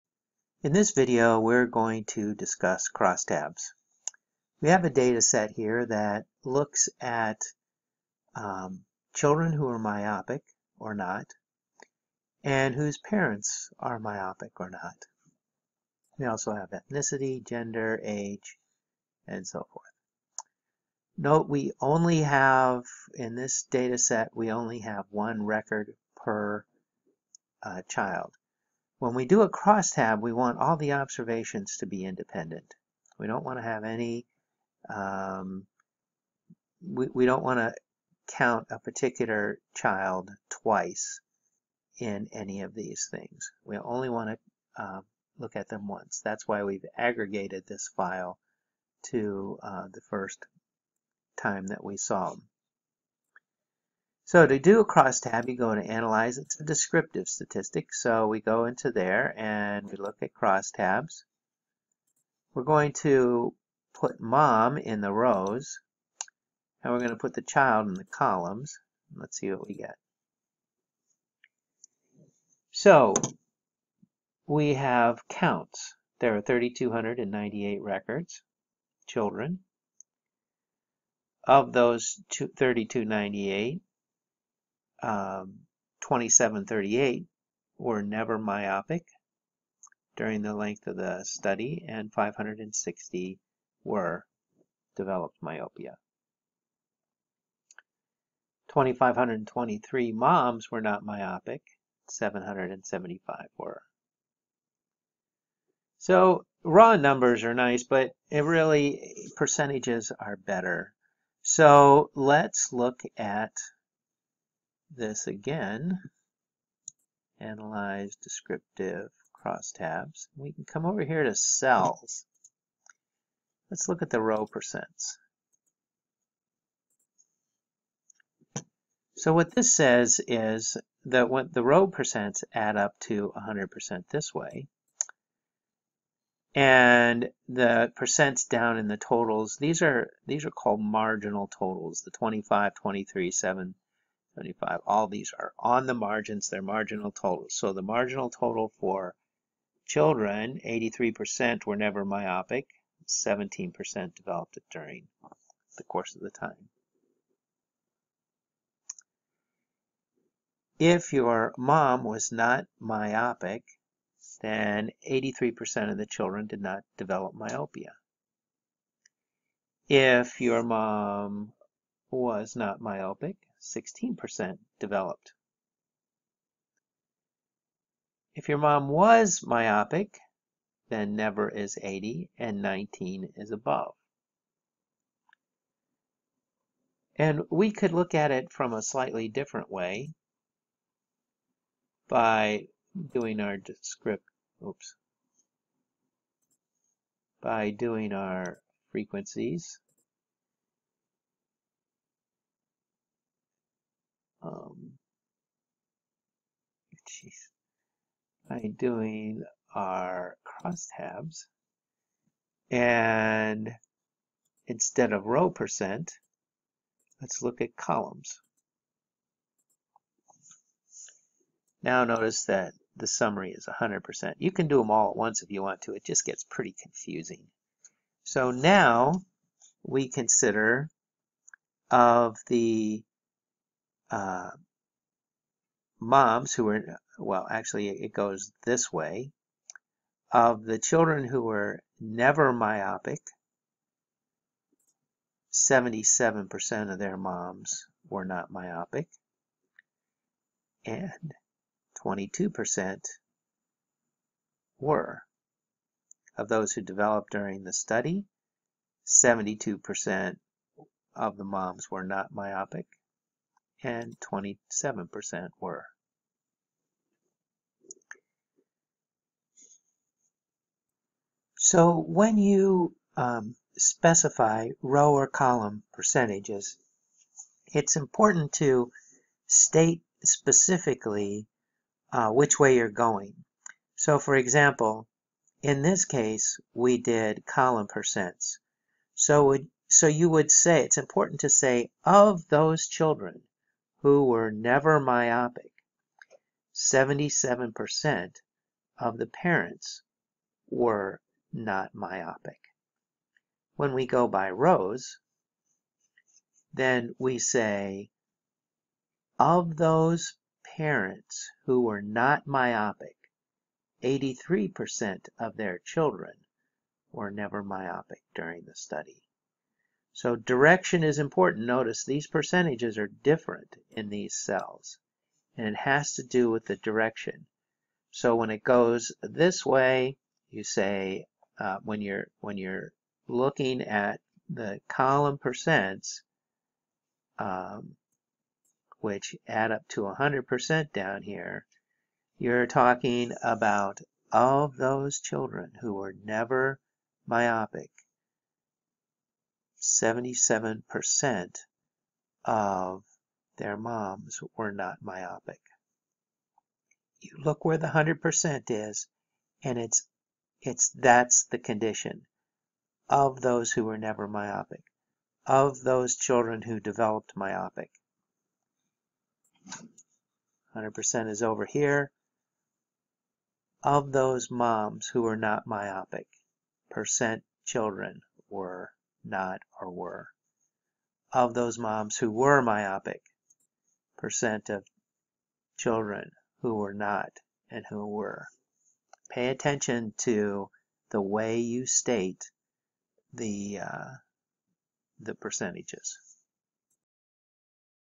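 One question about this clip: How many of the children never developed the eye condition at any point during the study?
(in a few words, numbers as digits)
2738.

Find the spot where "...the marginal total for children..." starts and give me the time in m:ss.
2:27.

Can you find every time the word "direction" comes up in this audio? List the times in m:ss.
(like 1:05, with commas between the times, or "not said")
5:20, 5:26.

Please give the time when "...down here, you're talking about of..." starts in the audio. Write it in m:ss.
5:40.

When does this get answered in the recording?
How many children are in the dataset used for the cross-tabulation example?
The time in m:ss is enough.
1:16.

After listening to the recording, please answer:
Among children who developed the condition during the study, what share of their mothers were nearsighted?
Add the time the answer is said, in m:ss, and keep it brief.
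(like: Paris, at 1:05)
27%, at 4:24.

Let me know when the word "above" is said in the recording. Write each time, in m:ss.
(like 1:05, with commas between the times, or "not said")
3:03.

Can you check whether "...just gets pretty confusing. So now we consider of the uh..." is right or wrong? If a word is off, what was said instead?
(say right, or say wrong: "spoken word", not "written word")
right.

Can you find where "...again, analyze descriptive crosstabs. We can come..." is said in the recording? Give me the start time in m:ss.
1:55.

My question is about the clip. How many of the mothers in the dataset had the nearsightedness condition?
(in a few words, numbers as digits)
775.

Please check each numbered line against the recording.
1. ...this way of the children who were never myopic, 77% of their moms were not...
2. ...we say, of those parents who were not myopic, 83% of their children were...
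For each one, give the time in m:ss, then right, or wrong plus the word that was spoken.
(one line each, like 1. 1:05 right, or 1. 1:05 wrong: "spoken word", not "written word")
1. 3:58 right
2. 5:07 right.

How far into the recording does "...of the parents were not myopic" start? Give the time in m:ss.
4:58.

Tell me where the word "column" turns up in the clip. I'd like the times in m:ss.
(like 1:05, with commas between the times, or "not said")
1:08, 3:37, 4:35, 4:47, 5:34.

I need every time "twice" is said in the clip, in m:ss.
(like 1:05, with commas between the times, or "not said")
0:40.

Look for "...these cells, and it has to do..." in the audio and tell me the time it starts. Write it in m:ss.
5:24.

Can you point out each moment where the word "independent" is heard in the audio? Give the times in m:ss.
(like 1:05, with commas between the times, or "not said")
0:32.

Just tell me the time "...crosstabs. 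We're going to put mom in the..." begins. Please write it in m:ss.
1:00.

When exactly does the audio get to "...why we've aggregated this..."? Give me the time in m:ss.
0:46.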